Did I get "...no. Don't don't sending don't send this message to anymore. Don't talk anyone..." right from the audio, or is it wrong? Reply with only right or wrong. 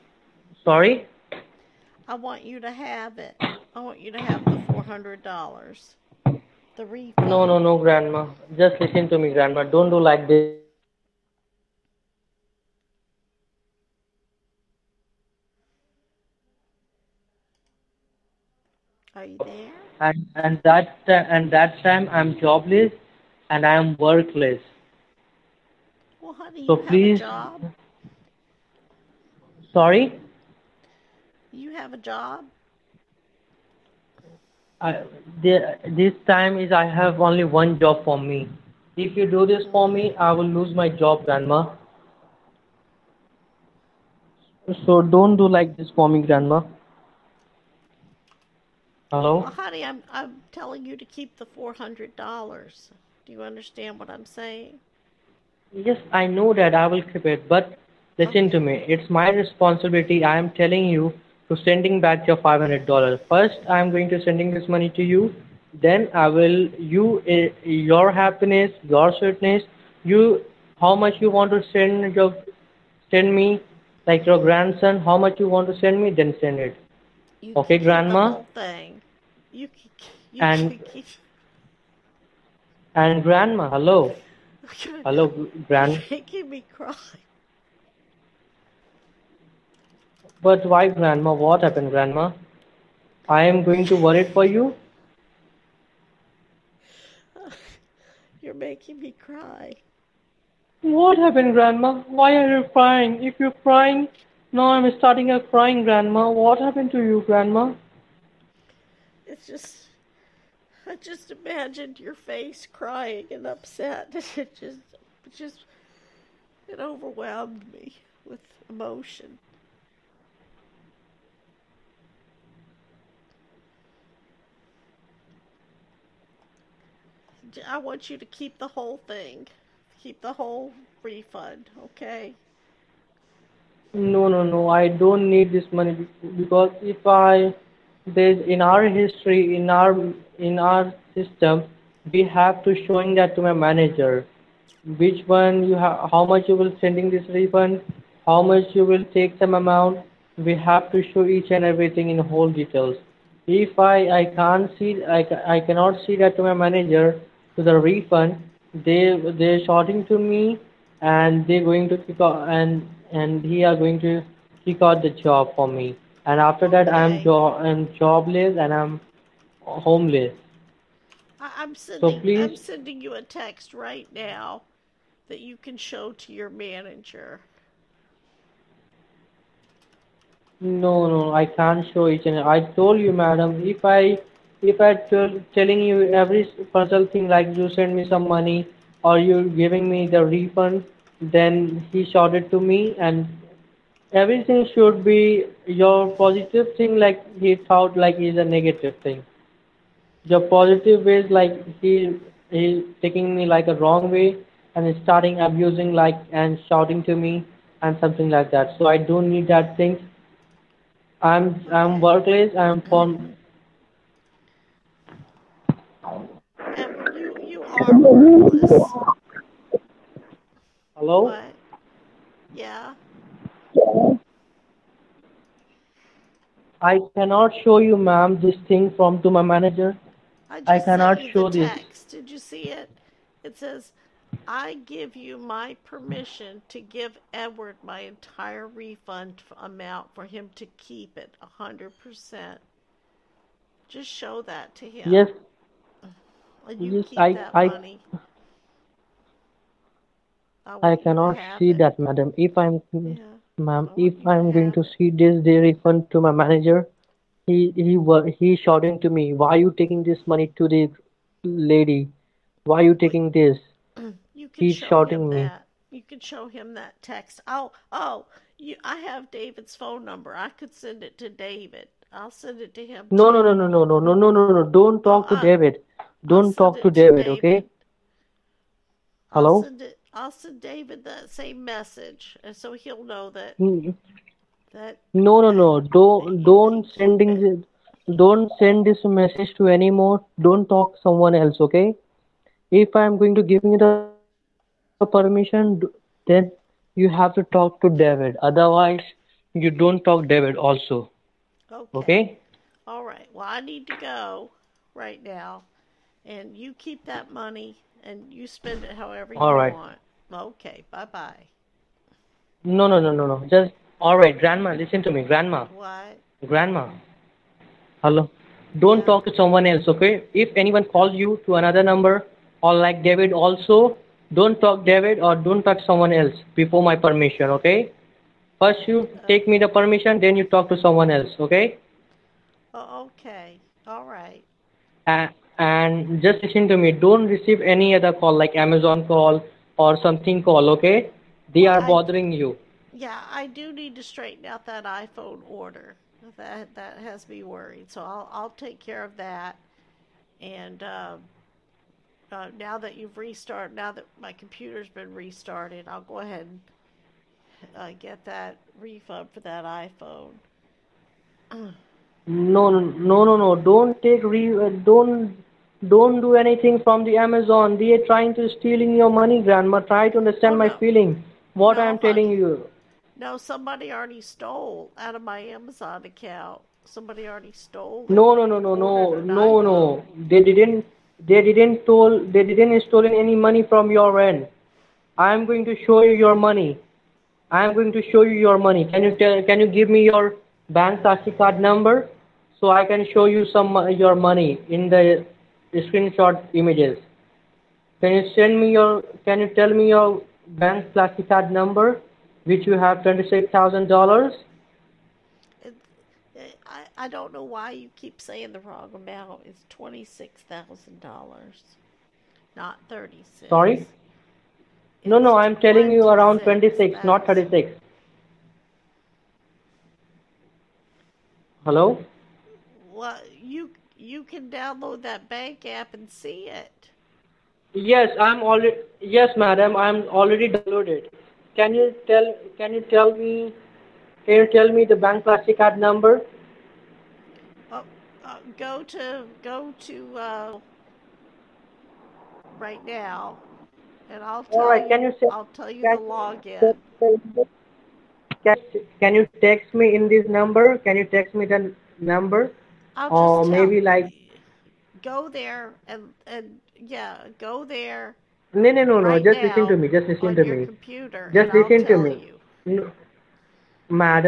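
wrong.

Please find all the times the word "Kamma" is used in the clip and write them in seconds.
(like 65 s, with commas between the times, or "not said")
not said.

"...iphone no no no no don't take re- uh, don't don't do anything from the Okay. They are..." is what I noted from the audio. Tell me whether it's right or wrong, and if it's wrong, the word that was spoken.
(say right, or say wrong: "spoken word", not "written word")
wrong: "Amazon", not "Okay".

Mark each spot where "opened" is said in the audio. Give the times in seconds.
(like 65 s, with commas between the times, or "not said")
not said.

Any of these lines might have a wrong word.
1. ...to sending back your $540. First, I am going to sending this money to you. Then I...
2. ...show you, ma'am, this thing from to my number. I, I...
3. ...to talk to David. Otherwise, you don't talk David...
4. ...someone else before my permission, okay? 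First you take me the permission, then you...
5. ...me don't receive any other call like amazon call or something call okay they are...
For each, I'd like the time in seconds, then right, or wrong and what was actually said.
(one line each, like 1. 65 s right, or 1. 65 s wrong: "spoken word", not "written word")
1. 61 s wrong: "500", not "540"
2. 227 s wrong: "manager", not "number"
3. 297 s right
4. 325 s right
5. 336 s right.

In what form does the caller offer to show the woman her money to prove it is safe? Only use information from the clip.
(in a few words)
screenshot images.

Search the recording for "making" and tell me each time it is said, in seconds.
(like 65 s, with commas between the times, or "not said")
86 s, 98 s.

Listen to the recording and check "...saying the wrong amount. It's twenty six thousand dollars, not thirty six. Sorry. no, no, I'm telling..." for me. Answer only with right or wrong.
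right.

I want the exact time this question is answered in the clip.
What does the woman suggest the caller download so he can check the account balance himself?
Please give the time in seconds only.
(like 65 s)
425 s.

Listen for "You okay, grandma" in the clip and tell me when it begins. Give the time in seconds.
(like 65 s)
77 s.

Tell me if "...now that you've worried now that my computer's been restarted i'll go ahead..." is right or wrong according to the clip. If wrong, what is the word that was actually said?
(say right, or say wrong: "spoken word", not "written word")
wrong: "restarted", not "worried".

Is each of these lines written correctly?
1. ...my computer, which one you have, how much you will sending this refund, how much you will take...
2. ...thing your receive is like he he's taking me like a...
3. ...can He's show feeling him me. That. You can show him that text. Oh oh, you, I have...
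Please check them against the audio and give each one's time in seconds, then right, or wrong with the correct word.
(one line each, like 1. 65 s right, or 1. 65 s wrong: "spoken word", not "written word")
1. 143 s wrong: "manager", not "computer"
2. 199 s wrong: "positive", not "receive"
3. 264 s wrong: "shouting", not "feeling".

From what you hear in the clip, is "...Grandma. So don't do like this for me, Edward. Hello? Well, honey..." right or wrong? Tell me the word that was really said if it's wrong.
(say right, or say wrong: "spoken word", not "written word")
wrong: "Grandma", not "Edward".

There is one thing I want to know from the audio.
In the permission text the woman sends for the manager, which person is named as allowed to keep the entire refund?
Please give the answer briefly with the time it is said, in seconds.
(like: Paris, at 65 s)
Edward, at 237 s.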